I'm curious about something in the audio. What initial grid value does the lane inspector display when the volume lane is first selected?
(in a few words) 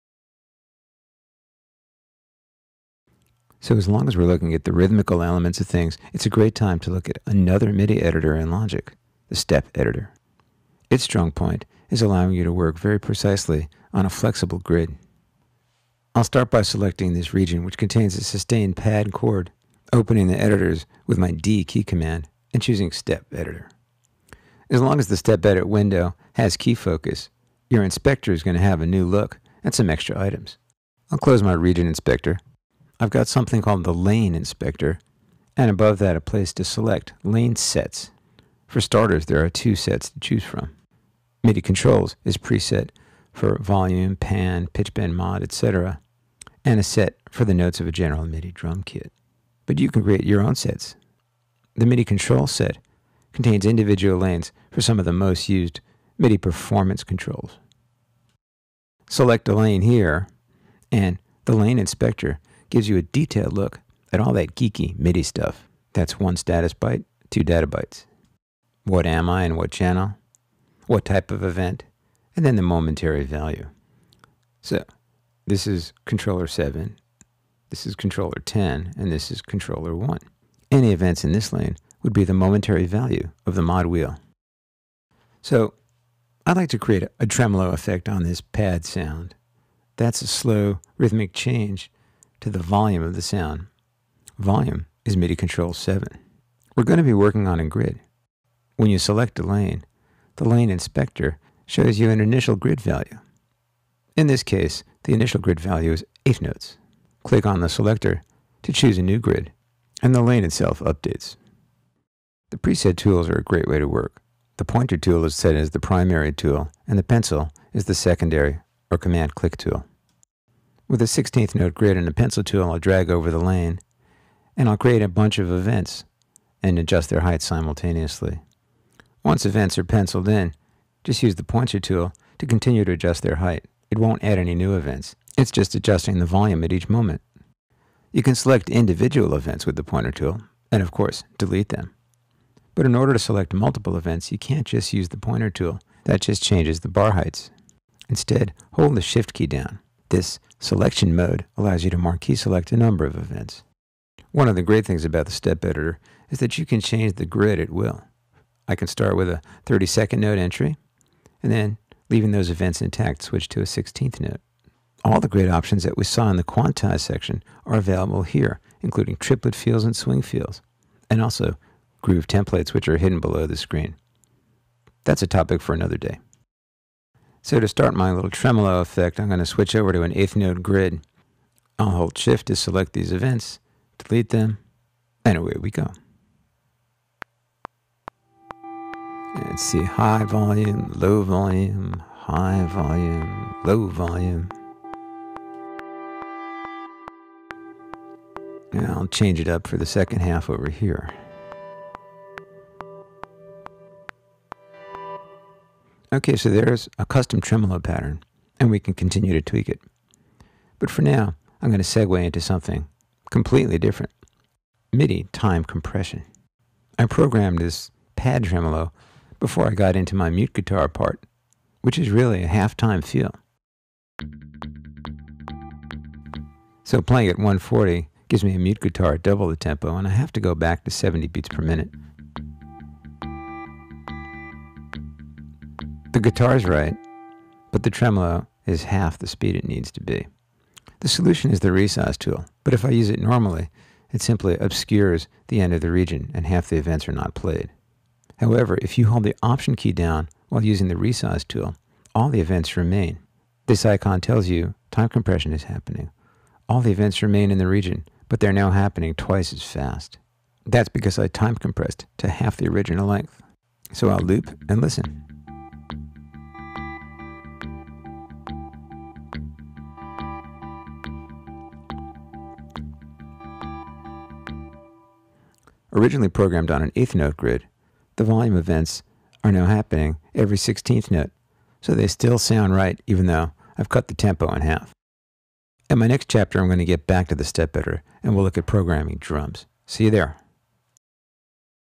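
8 notes.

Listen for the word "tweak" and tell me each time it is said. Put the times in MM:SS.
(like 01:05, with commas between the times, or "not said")
03:29.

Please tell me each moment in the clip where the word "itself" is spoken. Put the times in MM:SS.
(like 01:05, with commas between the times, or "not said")
01:50.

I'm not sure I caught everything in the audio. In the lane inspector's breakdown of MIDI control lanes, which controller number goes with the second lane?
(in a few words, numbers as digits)
10.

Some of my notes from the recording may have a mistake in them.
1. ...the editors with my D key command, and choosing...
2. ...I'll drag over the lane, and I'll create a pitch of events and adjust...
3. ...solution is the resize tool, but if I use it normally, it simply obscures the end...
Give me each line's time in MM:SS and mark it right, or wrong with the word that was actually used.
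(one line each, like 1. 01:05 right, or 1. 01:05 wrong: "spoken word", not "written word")
1. 00:20 right
2. 02:02 wrong: "bunch", not "pitch"
3. 04:01 right.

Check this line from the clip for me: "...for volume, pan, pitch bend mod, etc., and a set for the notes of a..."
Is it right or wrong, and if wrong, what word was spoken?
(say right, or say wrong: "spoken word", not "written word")
right.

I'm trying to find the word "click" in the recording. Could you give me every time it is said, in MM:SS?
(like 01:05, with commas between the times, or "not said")
01:47, 01:59.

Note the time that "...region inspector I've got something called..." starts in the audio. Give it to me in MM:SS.
00:31.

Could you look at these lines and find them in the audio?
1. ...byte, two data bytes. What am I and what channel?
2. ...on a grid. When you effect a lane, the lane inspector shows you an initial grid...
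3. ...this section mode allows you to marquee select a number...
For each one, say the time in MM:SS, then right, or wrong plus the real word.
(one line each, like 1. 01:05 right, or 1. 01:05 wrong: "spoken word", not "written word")
1. 01:06 right
2. 01:37 wrong: "select", not "effect"
3. 02:30 wrong: "selection", not "section".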